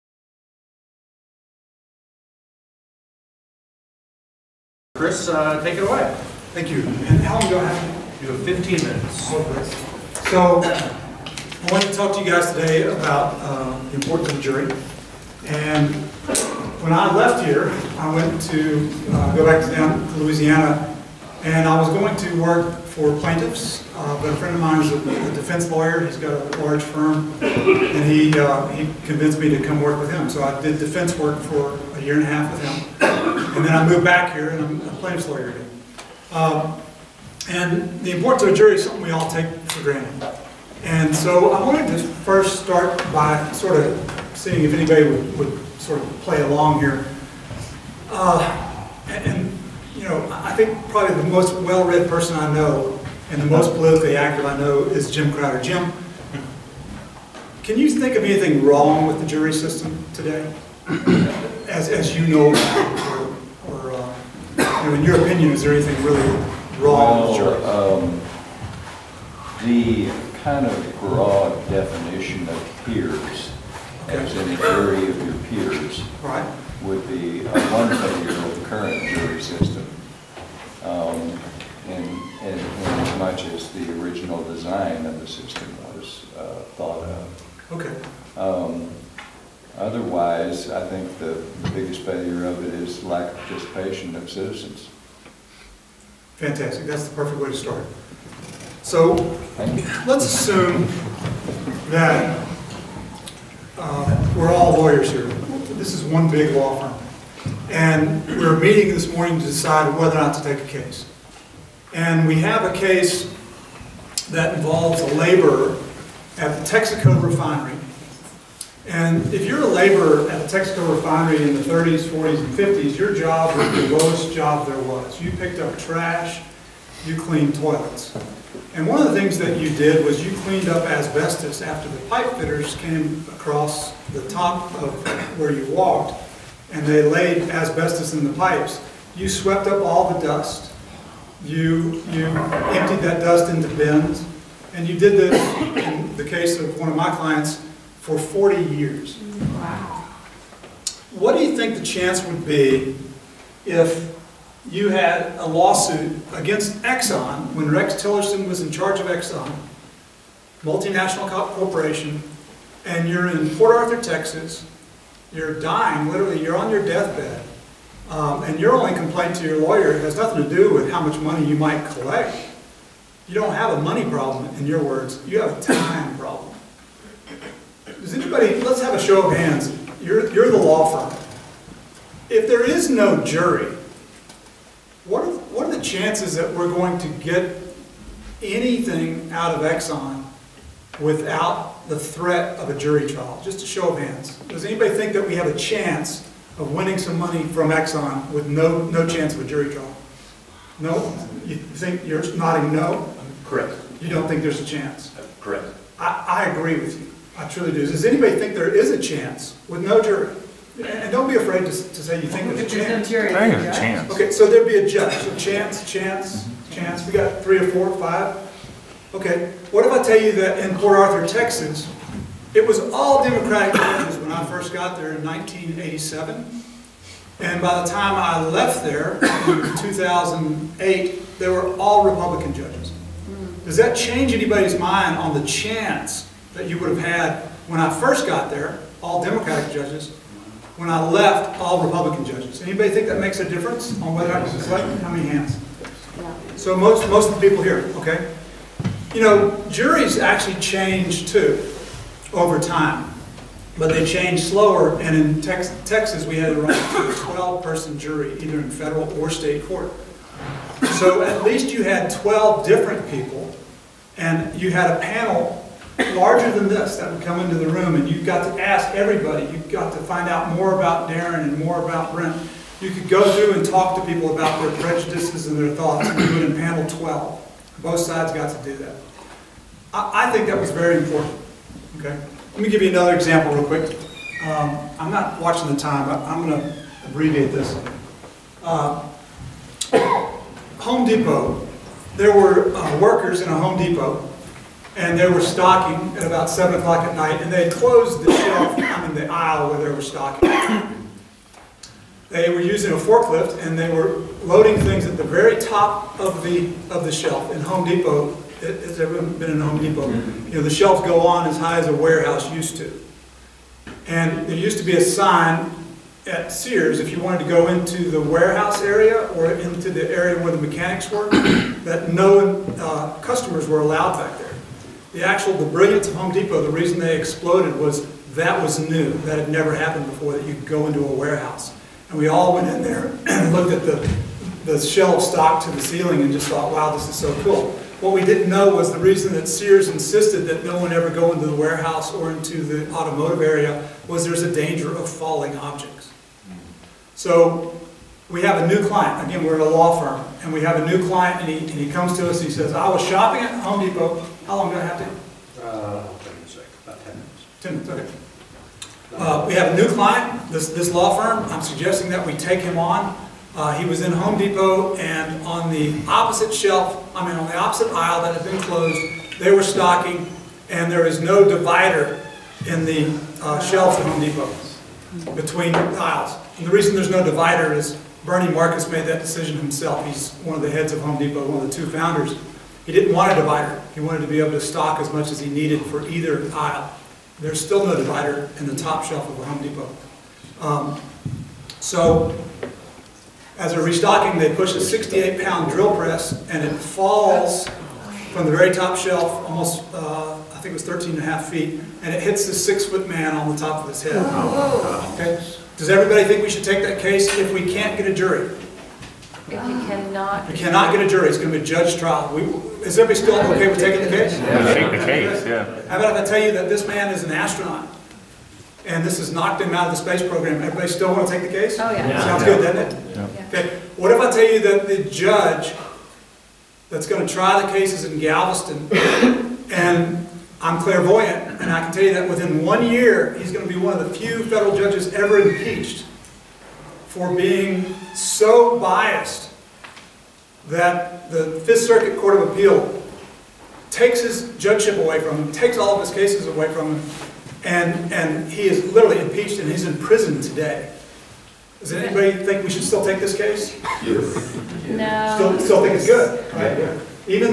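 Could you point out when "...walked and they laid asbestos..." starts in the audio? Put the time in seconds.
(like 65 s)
135 s.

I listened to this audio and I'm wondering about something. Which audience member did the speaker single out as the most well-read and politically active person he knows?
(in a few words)
Jim Crowder.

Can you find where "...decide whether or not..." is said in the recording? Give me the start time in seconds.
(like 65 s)
109 s.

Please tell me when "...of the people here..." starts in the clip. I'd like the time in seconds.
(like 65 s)
247 s.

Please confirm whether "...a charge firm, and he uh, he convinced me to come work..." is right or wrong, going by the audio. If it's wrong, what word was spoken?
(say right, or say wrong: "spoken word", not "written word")
wrong: "large", not "charge".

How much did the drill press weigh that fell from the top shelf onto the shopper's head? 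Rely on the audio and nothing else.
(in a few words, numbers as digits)
68 pounds.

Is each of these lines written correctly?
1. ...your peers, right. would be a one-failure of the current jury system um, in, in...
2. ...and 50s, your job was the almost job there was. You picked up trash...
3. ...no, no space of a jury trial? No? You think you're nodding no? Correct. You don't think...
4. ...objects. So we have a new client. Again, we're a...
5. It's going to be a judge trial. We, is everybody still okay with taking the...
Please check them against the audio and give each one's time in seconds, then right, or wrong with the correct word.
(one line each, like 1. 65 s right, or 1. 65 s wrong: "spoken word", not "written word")
1. 75 s right
2. 122 s wrong: "lowest", not "almost"
3. 198 s wrong: "chance", not "space"
4. 345 s right
5. 411 s right.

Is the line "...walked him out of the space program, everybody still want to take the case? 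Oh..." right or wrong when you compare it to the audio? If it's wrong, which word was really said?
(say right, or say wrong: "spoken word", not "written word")
wrong: "knocked", not "walked".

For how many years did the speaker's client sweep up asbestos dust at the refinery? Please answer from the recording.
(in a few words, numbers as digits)
40.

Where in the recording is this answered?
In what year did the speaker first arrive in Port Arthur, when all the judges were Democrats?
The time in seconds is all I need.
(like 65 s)
225 s.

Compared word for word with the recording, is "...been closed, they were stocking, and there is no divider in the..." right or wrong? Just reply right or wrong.
right.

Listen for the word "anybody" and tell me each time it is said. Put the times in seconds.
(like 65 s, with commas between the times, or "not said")
44 s, 178 s, 194 s, 208 s, 234 s, 242 s, 451 s.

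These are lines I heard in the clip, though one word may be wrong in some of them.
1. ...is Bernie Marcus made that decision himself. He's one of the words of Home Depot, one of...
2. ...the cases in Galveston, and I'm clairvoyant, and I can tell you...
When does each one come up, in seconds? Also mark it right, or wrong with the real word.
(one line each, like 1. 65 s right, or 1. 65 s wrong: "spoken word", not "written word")
1. 377 s wrong: "heads", not "words"
2. 427 s right.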